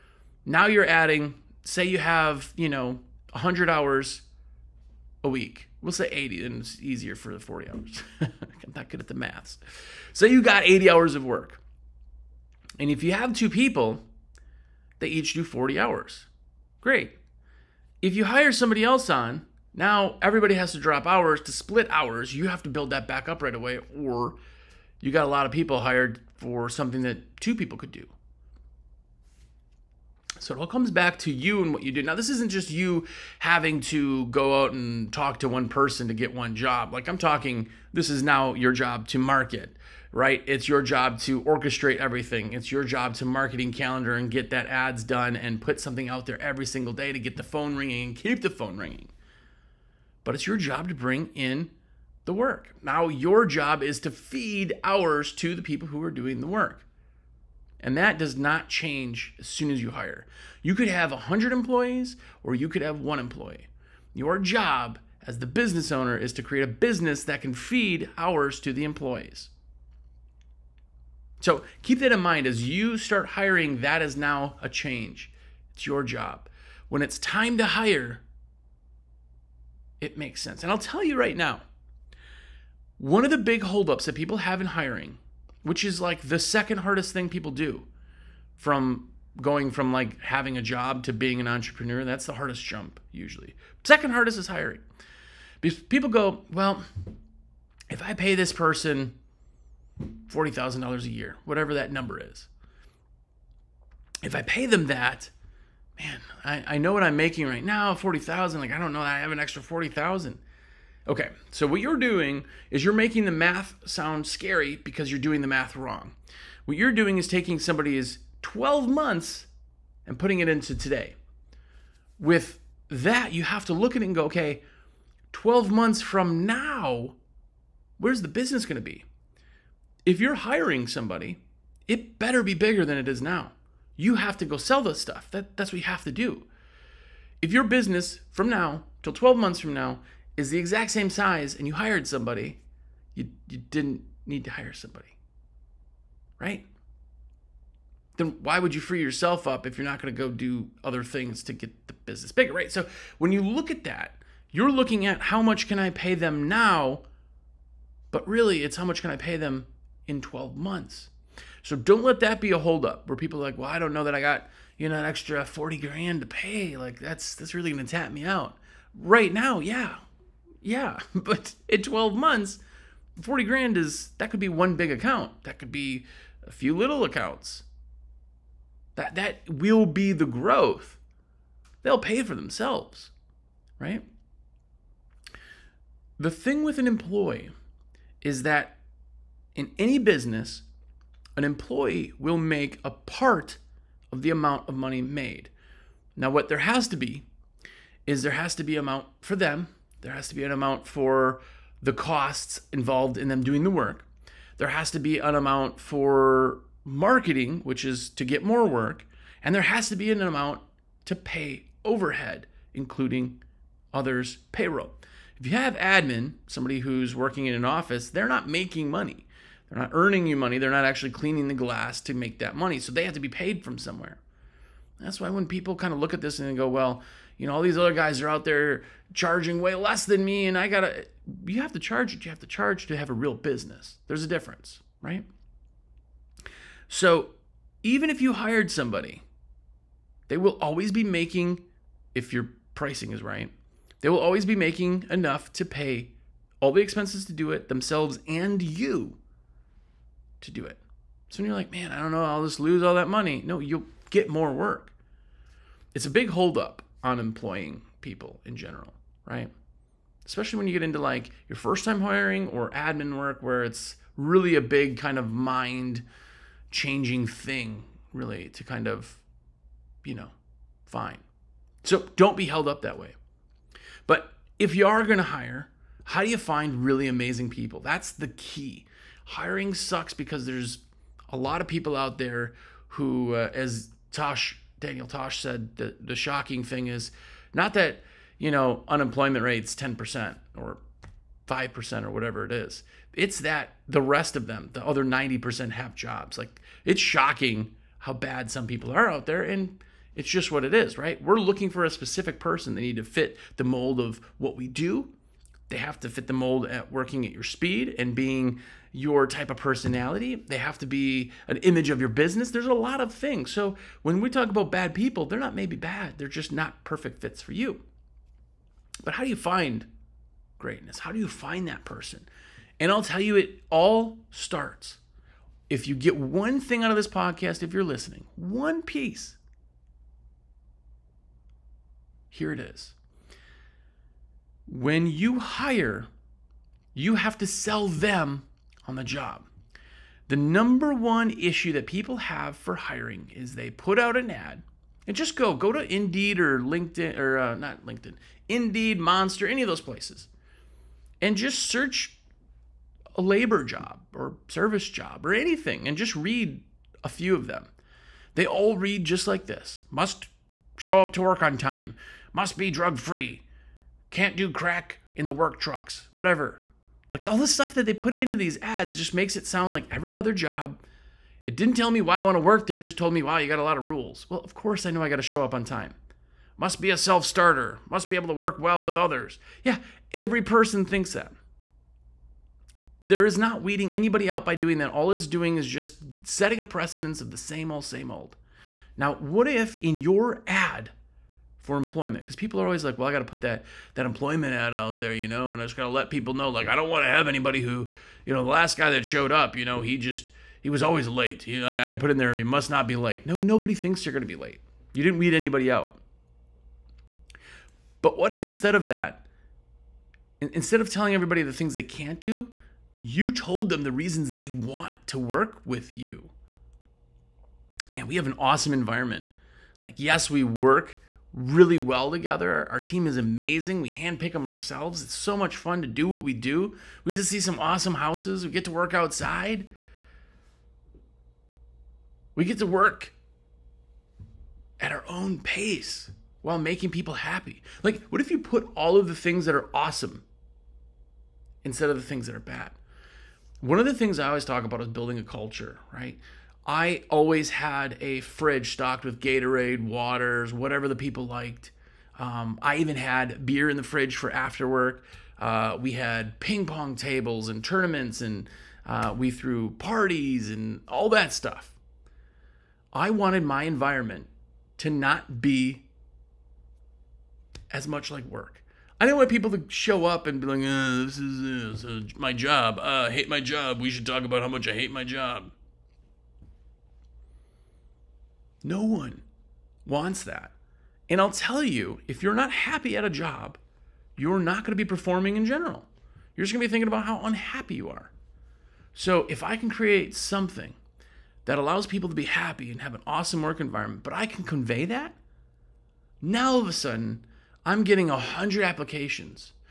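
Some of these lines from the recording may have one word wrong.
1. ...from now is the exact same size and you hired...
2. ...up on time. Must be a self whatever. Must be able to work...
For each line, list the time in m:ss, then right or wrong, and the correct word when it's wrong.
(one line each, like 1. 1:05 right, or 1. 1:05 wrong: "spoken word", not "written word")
1. 2:19 right
2. 6:15 wrong: "starter", not "whatever".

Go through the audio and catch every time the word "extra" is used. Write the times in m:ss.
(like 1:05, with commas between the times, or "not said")
1:49, 2:45.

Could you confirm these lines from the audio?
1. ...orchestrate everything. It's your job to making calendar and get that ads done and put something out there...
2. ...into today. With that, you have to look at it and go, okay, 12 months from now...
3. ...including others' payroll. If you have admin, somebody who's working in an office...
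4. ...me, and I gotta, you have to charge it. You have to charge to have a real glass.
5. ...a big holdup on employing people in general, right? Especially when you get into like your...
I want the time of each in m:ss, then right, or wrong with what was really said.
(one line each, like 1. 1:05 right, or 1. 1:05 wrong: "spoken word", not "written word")
1. 0:41 wrong: "marketing", not "making"
2. 2:00 right
3. 3:32 right
4. 3:50 wrong: "business", not "glass"
5. 4:16 right.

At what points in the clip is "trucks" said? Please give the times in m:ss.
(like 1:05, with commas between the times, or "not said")
6:05.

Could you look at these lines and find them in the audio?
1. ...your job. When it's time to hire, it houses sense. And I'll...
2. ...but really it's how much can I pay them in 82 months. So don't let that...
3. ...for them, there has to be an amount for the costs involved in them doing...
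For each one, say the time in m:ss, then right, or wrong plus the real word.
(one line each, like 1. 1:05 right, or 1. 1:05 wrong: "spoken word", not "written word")
1. 1:15 wrong: "makes", not "houses"
2. 2:38 wrong: "12", not "82"
3. 3:19 right.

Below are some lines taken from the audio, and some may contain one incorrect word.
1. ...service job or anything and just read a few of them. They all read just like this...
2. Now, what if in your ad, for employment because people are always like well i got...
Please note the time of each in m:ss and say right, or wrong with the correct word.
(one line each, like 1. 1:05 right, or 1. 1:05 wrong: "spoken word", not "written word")
1. 5:54 right
2. 6:28 right.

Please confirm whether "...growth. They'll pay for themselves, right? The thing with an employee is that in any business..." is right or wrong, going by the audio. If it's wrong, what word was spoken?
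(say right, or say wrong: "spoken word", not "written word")
right.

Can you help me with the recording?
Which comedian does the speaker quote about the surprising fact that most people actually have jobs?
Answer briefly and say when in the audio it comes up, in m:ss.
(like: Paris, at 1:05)
Daniel Tosh, at 4:44.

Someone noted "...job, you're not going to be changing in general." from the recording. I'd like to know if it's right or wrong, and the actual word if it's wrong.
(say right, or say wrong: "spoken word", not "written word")
wrong: "performing", not "changing".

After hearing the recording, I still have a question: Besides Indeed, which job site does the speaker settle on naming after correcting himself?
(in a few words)
Monster.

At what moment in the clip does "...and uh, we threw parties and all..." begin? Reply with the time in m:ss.
7:38.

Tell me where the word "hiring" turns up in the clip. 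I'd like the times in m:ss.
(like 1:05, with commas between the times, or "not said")
1:13, 1:24, 1:34, 2:10, 4:22, 4:39, 5:42.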